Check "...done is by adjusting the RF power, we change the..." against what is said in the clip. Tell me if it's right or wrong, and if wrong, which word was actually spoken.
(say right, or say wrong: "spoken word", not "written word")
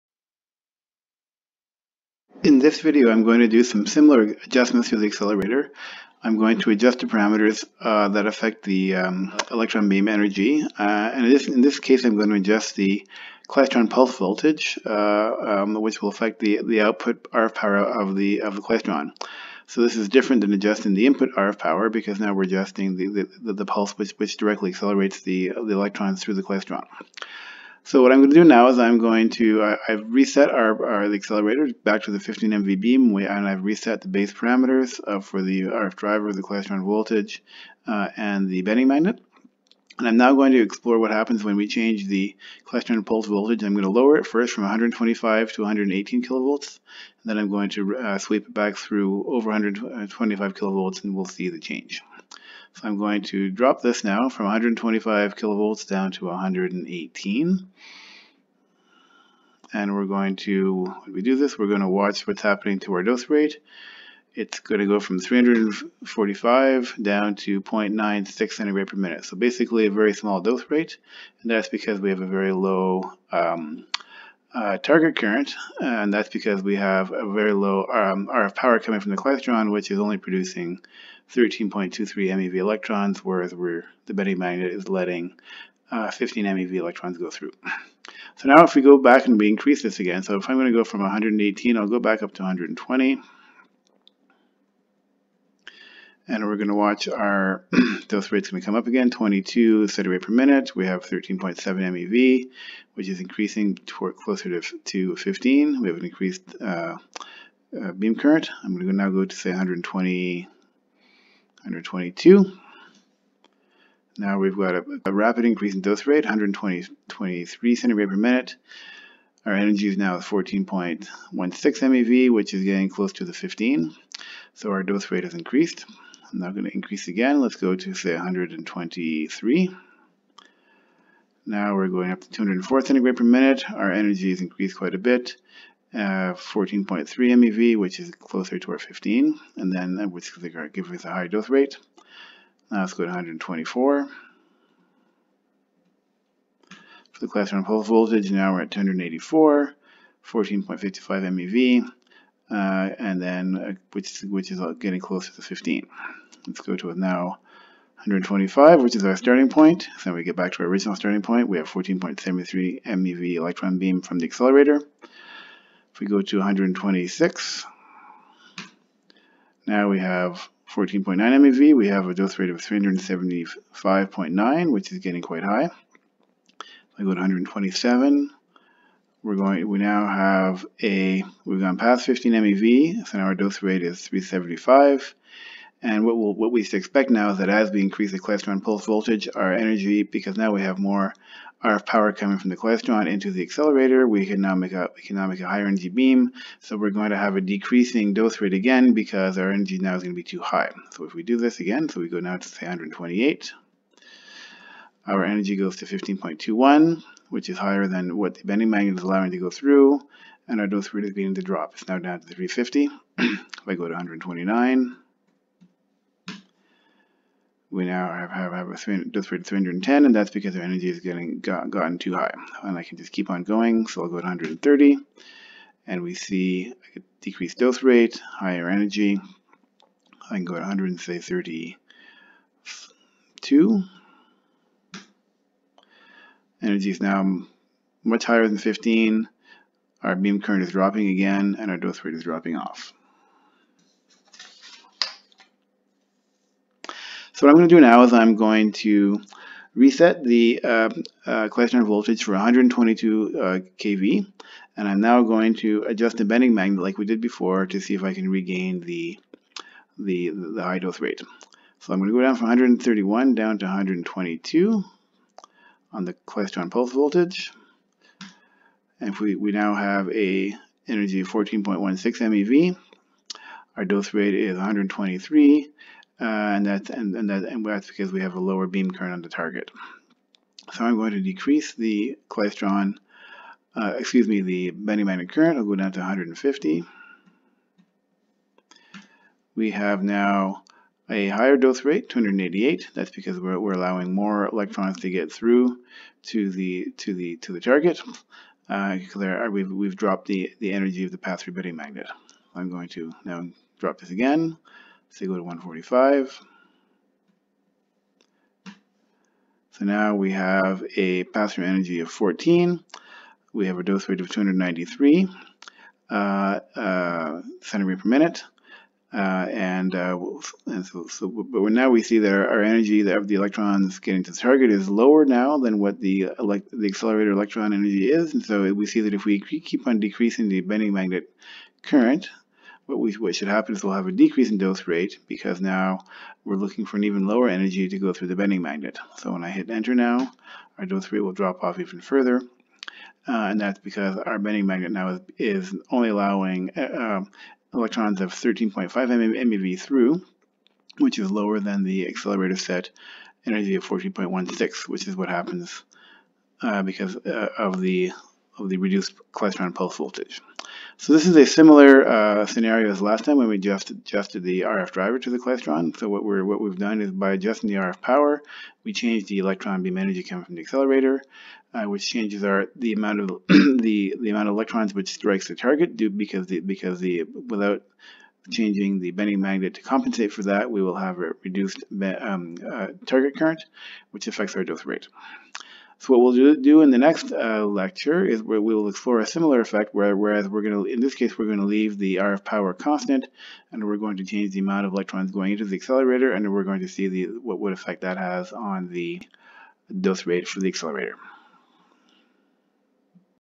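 right.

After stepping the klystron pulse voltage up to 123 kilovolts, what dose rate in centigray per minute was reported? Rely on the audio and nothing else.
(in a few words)
204.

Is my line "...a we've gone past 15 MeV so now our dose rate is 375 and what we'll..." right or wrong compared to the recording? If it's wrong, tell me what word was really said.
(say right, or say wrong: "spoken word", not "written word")
right.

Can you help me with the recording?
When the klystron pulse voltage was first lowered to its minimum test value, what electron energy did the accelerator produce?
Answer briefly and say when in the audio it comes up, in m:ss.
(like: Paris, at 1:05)
13.23 MeV, at 1:21.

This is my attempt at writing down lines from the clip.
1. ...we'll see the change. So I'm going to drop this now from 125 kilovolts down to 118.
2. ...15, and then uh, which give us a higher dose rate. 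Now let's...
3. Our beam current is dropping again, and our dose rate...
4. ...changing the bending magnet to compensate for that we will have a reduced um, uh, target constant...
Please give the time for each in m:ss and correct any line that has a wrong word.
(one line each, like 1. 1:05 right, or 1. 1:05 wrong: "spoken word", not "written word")
1. 0:51 right
2. 2:18 right
3. 4:00 right
4. 6:18 wrong: "current", not "constant".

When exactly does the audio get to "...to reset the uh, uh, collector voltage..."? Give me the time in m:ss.
4:08.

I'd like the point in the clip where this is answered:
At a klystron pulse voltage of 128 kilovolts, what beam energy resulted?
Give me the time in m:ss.
3:25.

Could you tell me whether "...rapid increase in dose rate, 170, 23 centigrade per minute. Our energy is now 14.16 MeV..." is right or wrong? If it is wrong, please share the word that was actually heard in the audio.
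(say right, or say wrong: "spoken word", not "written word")
wrong: "120", not "170".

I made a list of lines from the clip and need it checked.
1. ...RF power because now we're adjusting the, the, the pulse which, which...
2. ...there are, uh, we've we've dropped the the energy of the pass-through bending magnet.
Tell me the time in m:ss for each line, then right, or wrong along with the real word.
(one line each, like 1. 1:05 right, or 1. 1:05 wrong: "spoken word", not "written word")
1. 0:21 right
2. 4:59 right.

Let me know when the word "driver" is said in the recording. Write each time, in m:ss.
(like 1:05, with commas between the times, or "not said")
0:35, 6:04.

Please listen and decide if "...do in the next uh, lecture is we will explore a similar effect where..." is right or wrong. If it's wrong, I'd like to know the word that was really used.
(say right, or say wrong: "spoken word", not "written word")
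right.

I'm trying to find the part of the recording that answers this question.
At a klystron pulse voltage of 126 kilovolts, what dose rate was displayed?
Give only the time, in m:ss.
2:52.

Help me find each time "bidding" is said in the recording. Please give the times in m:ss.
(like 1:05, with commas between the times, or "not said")
not said.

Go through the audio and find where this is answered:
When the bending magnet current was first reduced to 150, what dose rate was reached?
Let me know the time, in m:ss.
4:52.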